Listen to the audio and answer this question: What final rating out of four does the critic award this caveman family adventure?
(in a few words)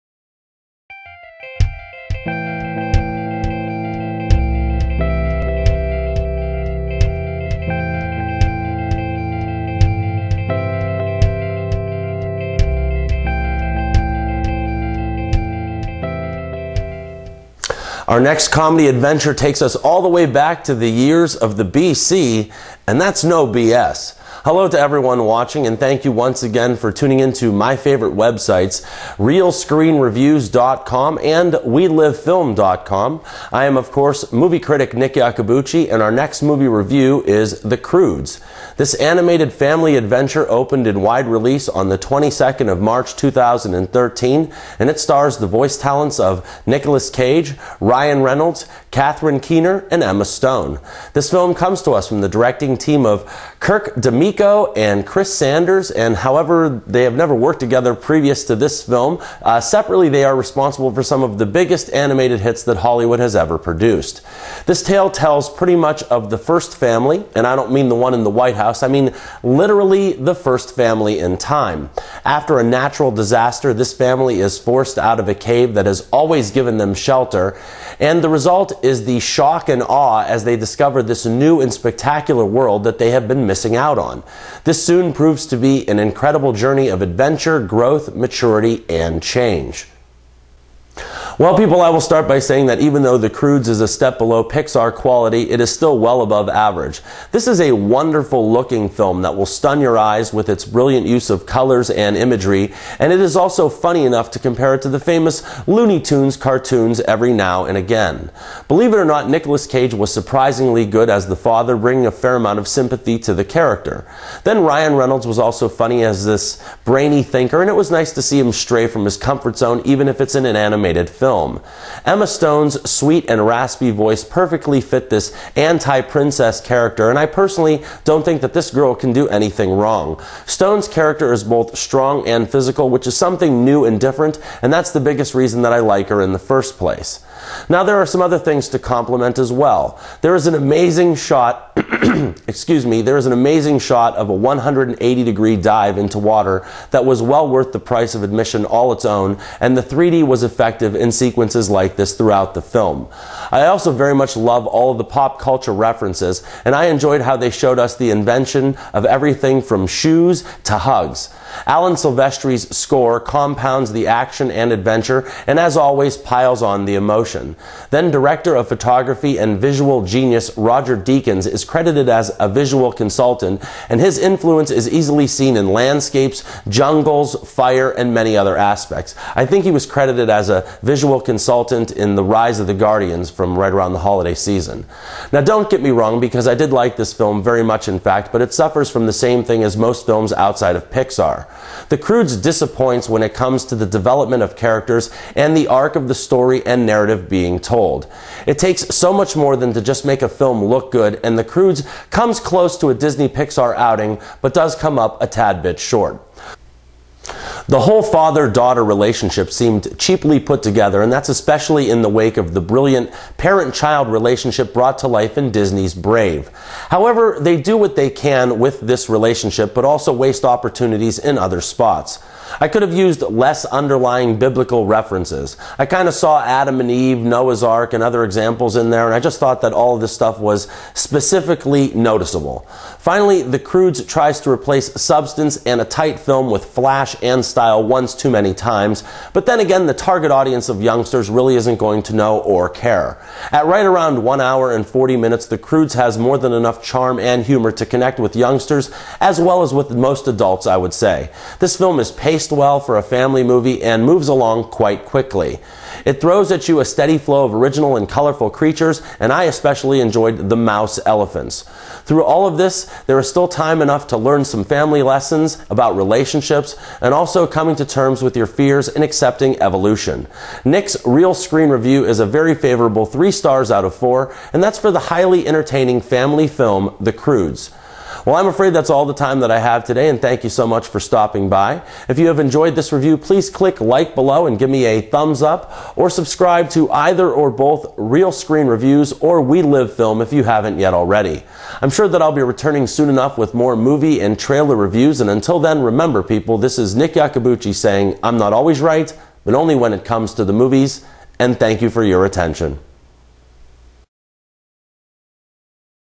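3 stars.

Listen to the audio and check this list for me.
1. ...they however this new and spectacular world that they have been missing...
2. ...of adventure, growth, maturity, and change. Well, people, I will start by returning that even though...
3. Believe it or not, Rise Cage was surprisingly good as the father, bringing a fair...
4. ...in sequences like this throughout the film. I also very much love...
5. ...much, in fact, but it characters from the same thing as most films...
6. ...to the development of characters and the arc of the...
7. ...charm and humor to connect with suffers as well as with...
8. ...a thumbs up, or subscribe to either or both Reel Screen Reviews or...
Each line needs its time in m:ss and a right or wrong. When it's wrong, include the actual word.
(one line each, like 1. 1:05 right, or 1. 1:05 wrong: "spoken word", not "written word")
1. 1:20 wrong: "discover", not "however"
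2. 1:26 wrong: "saying", not "returning"
3. 1:48 wrong: "Nicolas", not "Rise"
4. 2:30 right
5. 3:07 wrong: "suffers", not "characters"
6. 3:13 right
7. 4:06 wrong: "youngsters", not "suffers"
8. 4:44 right.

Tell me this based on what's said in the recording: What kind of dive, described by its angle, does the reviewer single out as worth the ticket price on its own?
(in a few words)
180 degree dive.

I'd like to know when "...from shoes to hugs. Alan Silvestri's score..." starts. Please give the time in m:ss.
2:39.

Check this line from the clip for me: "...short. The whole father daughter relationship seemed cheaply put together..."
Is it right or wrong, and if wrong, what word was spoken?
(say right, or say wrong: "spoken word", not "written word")
right.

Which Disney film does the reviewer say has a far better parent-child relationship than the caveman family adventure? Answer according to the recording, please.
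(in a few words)
Brave.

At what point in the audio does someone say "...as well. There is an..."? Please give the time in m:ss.
2:19.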